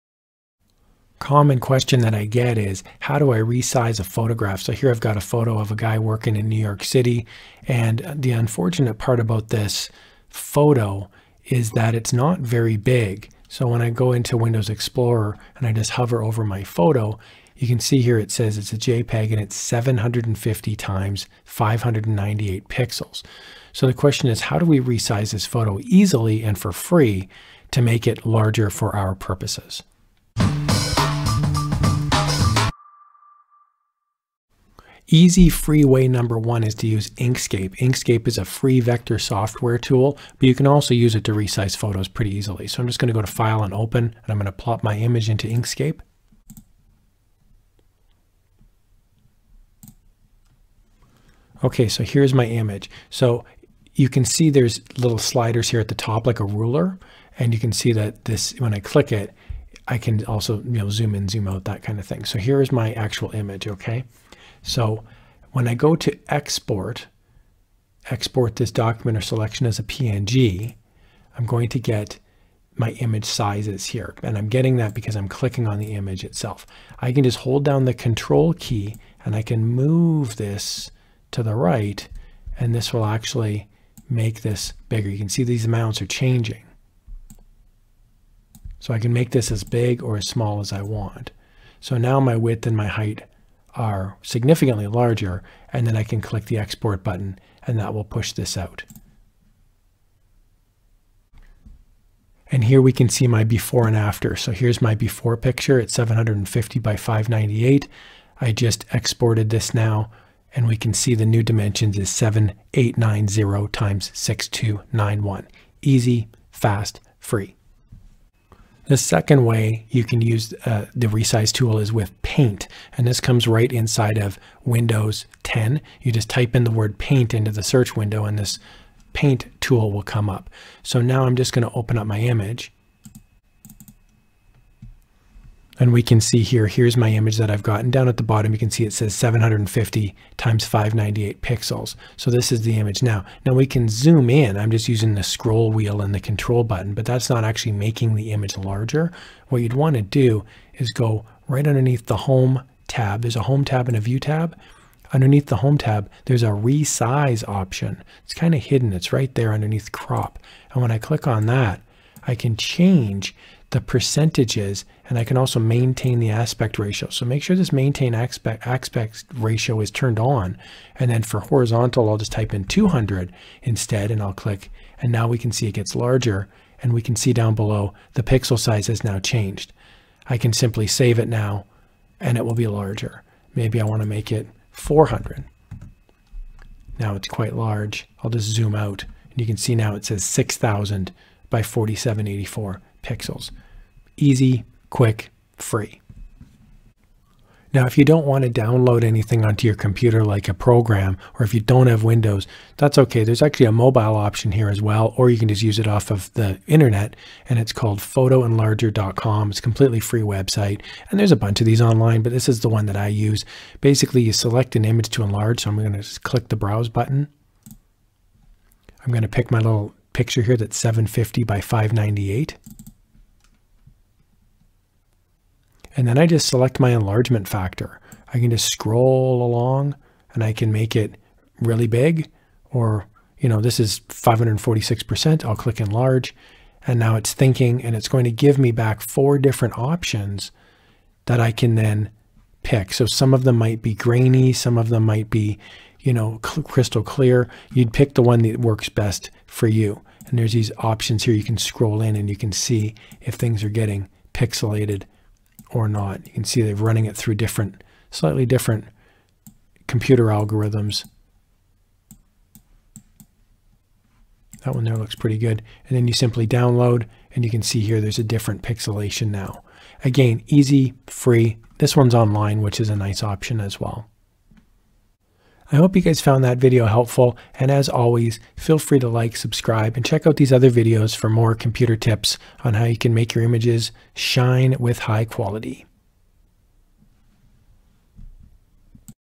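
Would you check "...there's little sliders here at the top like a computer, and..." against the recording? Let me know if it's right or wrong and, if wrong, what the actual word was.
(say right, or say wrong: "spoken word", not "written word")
wrong: "ruler", not "computer".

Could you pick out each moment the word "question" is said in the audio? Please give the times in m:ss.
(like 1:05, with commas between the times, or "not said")
0:01, 0:23.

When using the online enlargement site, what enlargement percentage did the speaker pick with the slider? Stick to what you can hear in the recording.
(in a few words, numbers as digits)
546%.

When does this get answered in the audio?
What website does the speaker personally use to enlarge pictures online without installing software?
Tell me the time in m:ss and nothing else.
3:27.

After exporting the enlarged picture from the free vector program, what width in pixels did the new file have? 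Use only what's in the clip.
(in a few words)
7890.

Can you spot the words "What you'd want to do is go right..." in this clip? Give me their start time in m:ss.
2:29.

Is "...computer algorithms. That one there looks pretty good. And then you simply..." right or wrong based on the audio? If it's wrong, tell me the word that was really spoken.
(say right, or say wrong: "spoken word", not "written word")
right.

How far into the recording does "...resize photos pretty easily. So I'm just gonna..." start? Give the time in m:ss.
0:41.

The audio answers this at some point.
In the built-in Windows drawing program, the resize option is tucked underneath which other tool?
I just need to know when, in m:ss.
2:39.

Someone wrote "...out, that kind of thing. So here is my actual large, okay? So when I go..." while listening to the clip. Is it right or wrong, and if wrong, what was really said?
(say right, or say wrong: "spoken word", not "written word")
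wrong: "image", not "large".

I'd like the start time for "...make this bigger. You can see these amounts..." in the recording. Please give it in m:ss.
1:24.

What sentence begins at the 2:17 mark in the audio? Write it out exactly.
Down at the bottom, you can see it says 750 times 598 pixels.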